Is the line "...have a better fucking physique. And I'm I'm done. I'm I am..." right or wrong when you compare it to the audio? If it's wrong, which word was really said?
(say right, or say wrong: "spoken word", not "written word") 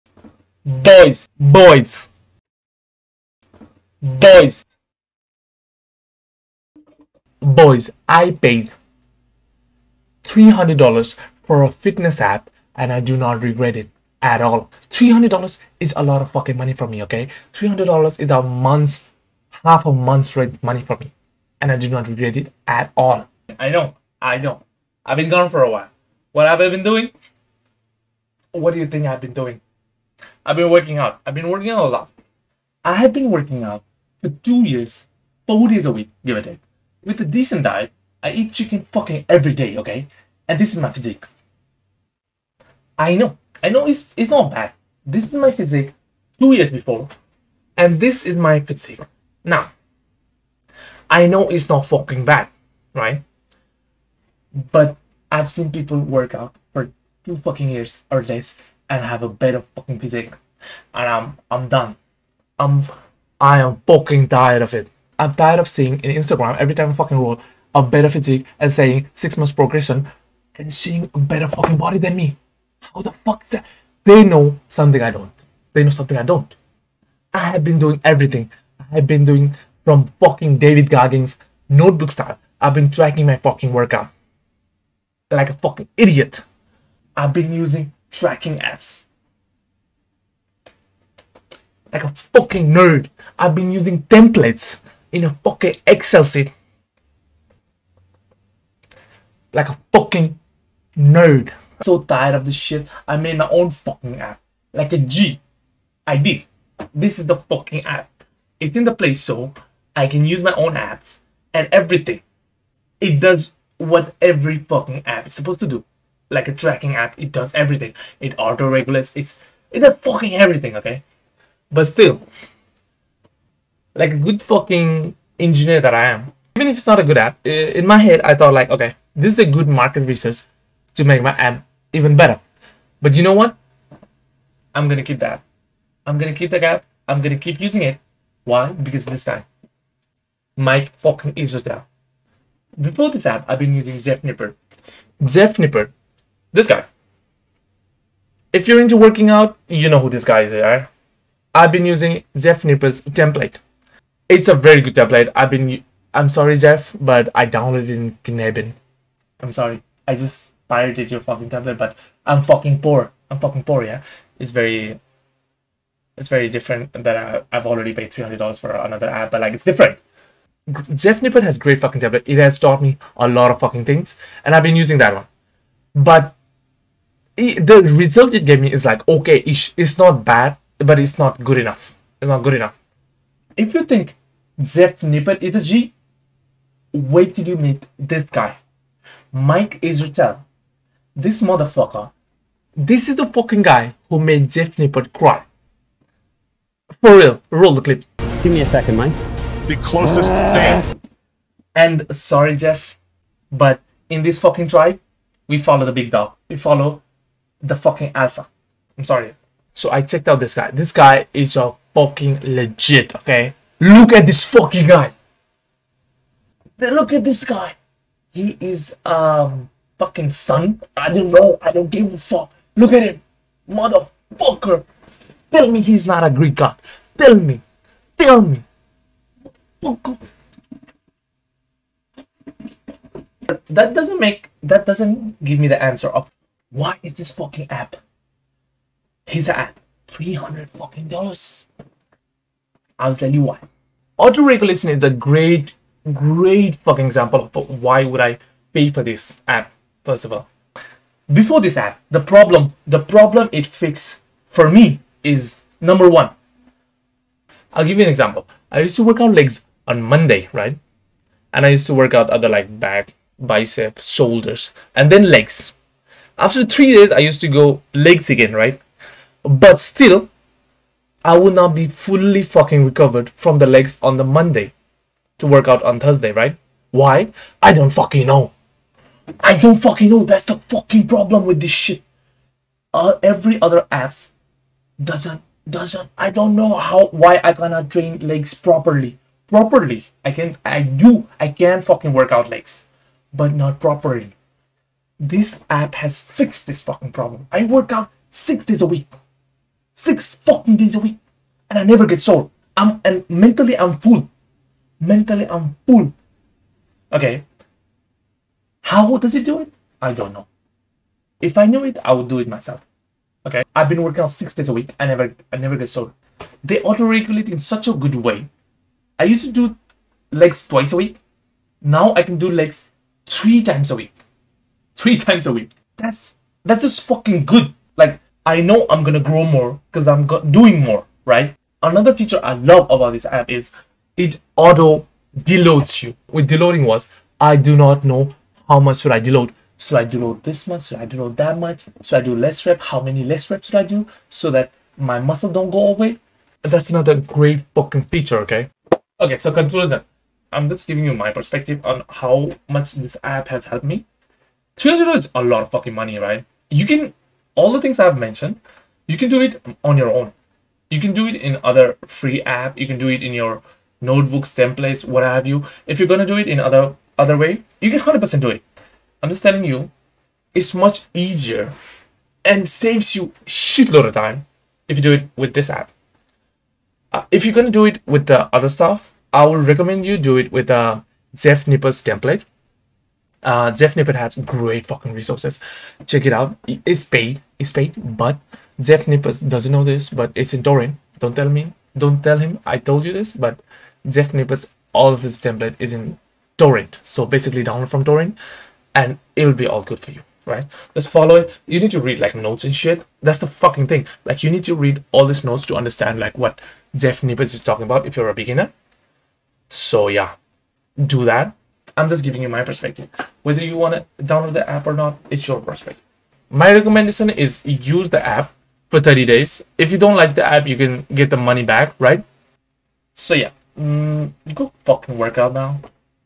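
right.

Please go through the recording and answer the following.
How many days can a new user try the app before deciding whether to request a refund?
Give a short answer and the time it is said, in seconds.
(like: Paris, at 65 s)
30 days, at 418 s.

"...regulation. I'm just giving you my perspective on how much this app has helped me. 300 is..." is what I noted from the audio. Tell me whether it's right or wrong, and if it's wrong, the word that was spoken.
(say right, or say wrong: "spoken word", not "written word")
wrong: "conclusion", not "regulation".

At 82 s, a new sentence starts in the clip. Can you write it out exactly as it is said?
I've been tracking my fucking workout like a fucking idiot.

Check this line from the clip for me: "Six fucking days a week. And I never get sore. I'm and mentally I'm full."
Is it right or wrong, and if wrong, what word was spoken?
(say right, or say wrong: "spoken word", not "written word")
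right.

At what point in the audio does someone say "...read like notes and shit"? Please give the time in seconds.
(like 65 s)
401 s.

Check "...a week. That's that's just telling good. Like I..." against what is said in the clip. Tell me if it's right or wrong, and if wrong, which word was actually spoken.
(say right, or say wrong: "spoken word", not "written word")
wrong: "fucking", not "telling".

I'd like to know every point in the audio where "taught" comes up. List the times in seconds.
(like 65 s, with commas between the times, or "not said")
172 s.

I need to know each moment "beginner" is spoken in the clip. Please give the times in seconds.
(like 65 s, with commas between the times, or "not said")
408 s.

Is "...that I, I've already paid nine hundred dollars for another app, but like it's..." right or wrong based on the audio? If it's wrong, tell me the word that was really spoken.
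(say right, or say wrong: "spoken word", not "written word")
wrong: "three", not "nine".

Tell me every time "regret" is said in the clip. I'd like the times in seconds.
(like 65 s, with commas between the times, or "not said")
13 s, 22 s.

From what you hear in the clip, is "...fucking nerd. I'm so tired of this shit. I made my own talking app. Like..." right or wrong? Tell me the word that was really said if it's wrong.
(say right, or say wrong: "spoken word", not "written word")
wrong: "fucking", not "talking".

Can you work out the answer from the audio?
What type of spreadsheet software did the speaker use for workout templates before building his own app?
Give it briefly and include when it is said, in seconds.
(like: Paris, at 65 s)
Excel, at 95 s.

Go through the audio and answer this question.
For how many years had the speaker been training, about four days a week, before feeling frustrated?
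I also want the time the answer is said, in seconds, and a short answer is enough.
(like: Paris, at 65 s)
2 years, at 34 s.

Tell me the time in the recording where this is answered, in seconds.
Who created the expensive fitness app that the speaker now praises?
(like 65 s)
189 s.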